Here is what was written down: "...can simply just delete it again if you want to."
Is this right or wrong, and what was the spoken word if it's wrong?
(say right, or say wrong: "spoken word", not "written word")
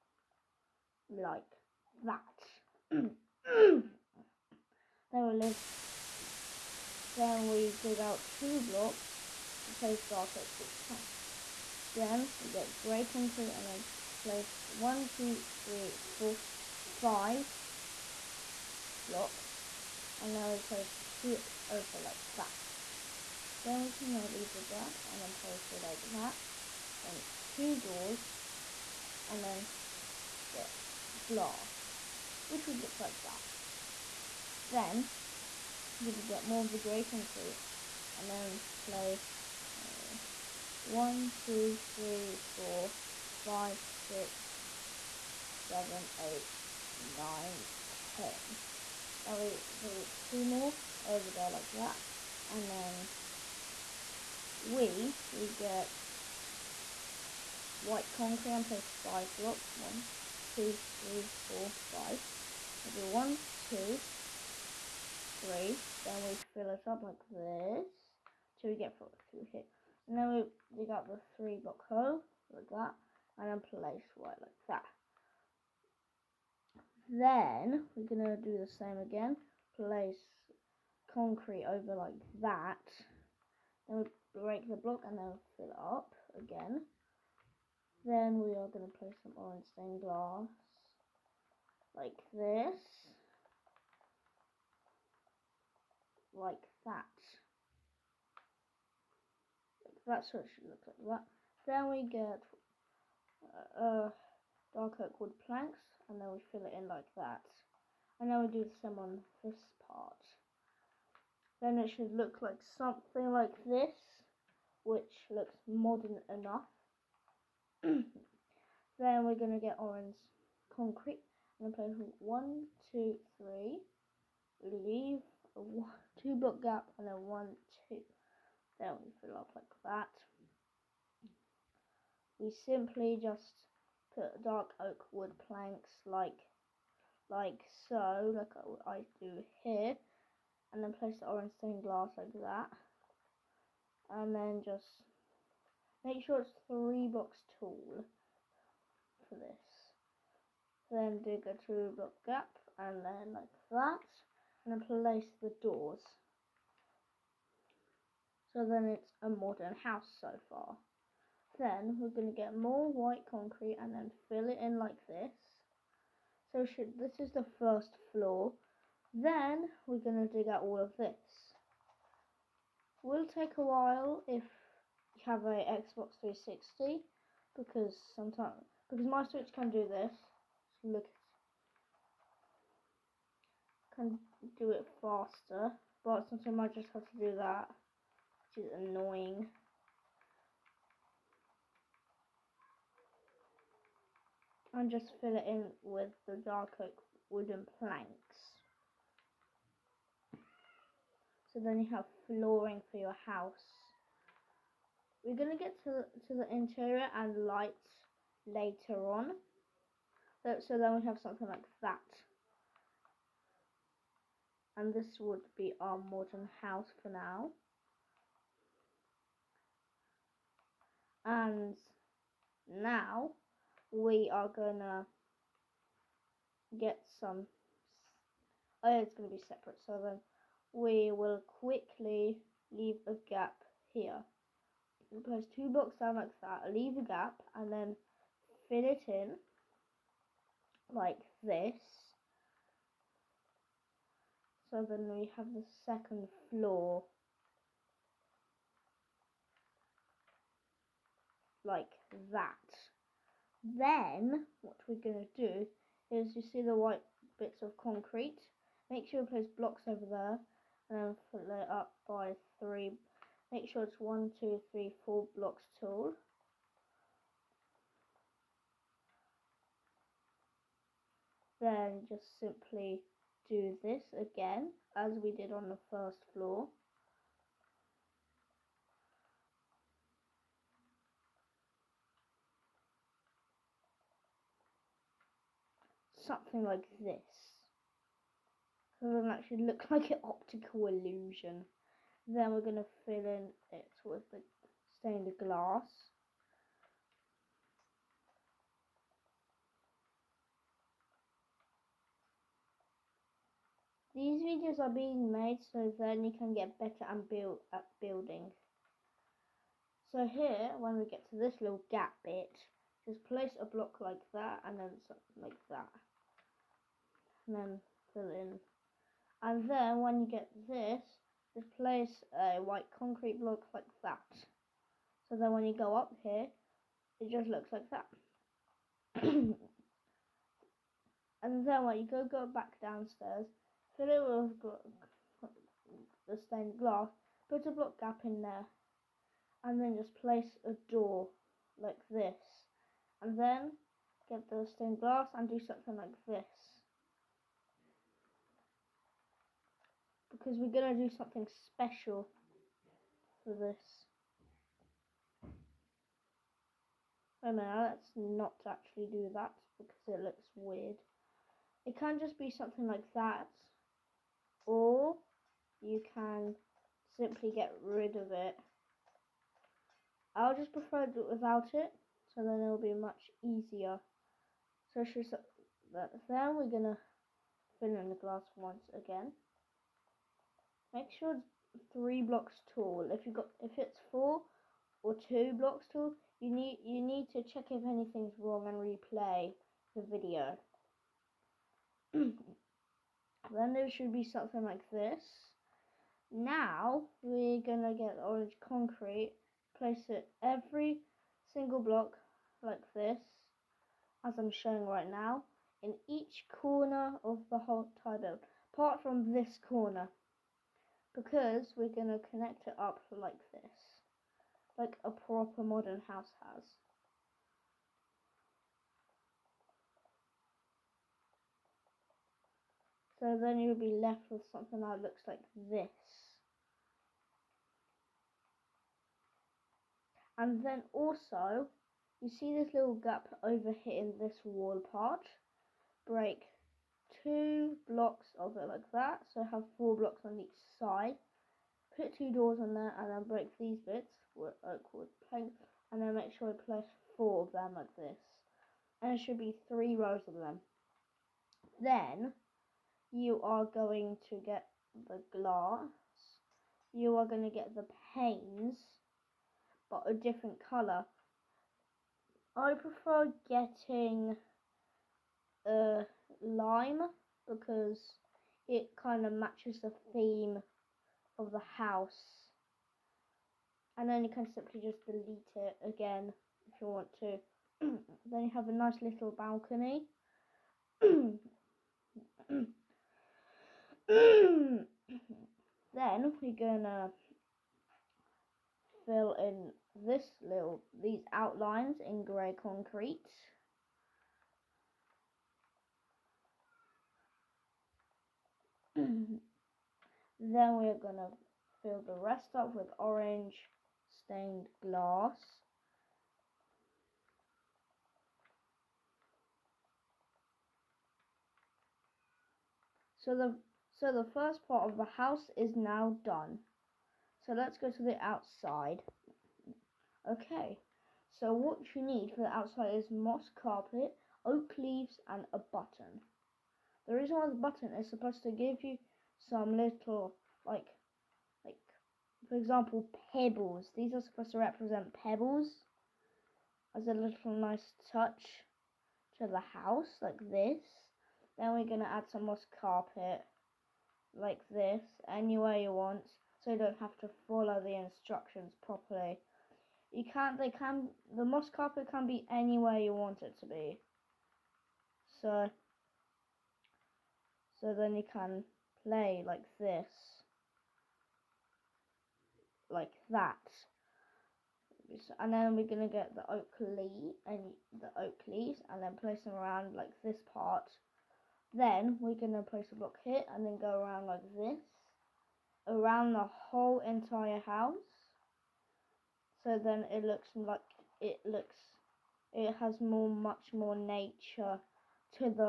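right.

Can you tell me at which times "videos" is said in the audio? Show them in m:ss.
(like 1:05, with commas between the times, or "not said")
5:04, 6:30.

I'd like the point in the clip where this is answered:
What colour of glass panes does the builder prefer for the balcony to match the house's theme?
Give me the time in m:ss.
7:46.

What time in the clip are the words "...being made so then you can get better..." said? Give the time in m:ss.
5:04.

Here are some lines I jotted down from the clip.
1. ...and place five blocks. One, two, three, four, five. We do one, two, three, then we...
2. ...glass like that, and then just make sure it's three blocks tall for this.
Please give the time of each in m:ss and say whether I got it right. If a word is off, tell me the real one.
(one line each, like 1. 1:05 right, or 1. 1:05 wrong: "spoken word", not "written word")
1. 0:58 right
2. 2:21 right.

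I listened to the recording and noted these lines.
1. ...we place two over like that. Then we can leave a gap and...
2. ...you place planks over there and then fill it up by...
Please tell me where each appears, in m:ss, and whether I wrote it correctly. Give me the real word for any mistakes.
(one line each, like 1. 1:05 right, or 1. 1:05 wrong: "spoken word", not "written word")
1. 0:20 right
2. 4:19 wrong: "blocks", not "planks".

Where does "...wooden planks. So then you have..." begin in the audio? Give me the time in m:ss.
3:17.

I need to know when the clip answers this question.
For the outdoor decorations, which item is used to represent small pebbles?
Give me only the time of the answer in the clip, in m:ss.
8:45.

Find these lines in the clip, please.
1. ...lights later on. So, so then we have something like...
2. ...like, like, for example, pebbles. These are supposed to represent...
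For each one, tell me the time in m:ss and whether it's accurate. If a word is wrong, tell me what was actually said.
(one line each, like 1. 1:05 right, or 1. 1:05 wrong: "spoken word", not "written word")
1. 3:27 right
2. 8:50 right.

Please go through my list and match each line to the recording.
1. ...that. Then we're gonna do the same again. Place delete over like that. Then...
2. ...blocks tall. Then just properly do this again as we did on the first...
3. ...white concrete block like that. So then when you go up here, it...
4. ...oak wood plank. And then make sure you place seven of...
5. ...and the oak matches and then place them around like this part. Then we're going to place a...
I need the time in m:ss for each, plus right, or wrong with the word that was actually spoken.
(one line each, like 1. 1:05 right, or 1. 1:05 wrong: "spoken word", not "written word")
1. 1:14 wrong: "concrete", not "delete"
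2. 4:25 wrong: "simply", not "properly"
3. 5:22 right
4. 7:24 wrong: "four", not "seven"
5. 9:27 wrong: "leaves", not "matches".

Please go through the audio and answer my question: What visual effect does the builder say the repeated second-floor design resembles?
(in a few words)
An optical illusion.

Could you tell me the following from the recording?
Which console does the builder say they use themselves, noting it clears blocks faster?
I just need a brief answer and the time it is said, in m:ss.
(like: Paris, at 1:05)
Switch, at 2:59.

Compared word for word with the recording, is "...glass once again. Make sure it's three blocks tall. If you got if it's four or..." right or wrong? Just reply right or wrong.
right.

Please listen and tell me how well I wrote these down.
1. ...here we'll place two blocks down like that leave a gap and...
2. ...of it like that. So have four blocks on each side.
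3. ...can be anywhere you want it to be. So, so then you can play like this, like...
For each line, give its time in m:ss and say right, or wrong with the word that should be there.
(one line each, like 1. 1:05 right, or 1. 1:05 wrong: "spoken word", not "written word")
1. 3:53 right
2. 7:18 right
3. 9:12 right.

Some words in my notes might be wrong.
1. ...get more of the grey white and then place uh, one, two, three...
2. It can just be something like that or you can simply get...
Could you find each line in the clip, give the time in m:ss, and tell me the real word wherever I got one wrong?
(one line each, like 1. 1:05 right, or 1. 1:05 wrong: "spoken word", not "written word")
1. 0:36 wrong: "concrete", not "white"
2. 6:01 right.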